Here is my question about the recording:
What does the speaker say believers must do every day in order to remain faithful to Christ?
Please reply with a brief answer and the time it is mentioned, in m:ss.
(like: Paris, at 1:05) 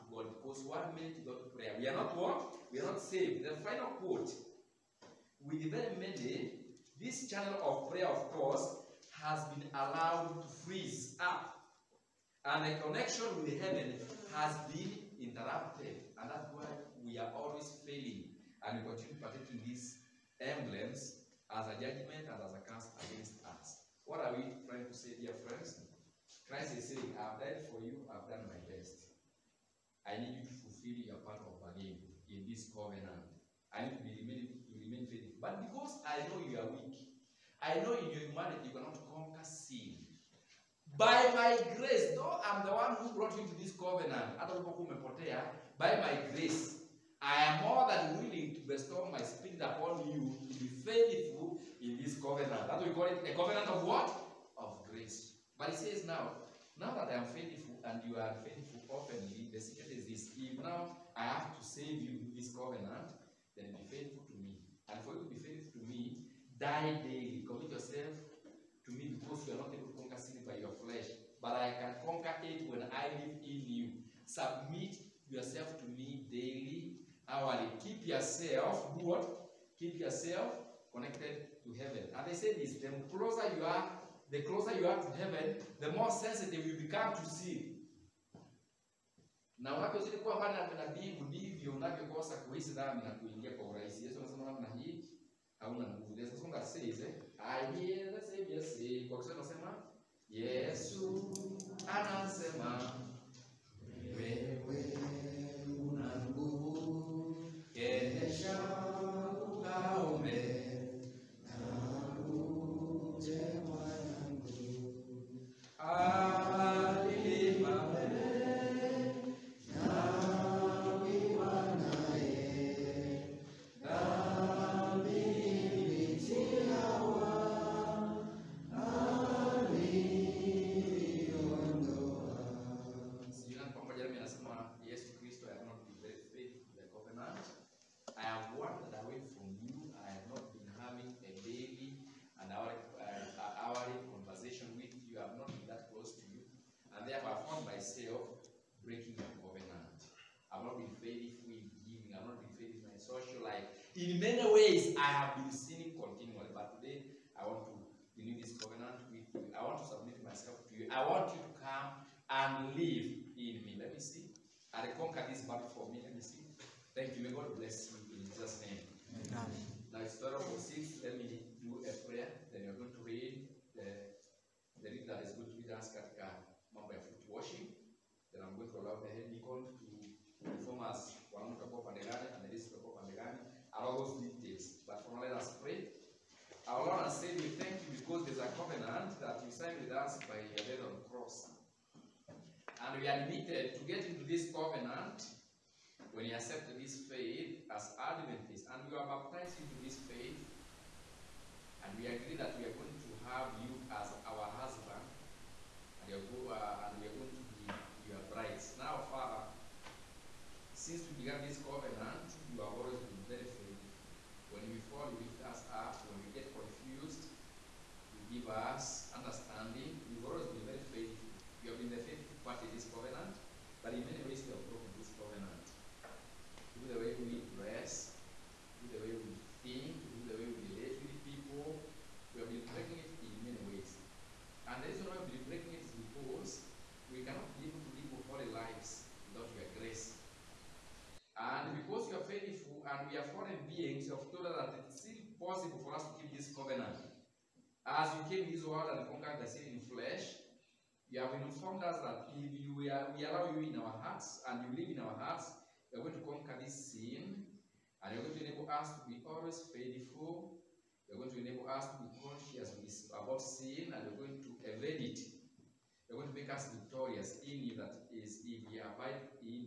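Die daily, at 1:06.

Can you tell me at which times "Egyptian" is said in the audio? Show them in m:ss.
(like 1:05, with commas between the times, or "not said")
not said.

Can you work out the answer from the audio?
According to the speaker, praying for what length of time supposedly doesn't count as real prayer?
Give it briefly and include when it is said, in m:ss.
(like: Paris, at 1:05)
One minute, at 0:00.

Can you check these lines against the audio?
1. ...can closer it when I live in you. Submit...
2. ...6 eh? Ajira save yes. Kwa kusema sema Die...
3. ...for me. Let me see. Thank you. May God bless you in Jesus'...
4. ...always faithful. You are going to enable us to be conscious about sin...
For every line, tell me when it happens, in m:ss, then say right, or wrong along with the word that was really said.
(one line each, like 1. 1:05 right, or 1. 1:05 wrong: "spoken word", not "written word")
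1. 1:11 wrong: "conquer", not "closer"
2. 1:36 wrong: "Yesu", not "Die"
3. 2:45 right
4. 4:19 right.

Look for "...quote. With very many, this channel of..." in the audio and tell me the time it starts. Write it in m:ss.
0:04.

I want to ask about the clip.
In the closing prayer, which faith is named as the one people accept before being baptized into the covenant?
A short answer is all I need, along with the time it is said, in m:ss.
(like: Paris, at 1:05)
Adventist, at 3:18.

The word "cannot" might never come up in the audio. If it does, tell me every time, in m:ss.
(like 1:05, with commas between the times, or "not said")
0:38, 3:57.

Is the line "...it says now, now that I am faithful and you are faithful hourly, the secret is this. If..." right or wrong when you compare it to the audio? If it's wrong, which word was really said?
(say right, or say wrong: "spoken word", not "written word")
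wrong: "openly", not "hourly".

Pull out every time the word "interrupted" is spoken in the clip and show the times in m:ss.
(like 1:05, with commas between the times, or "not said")
0:15.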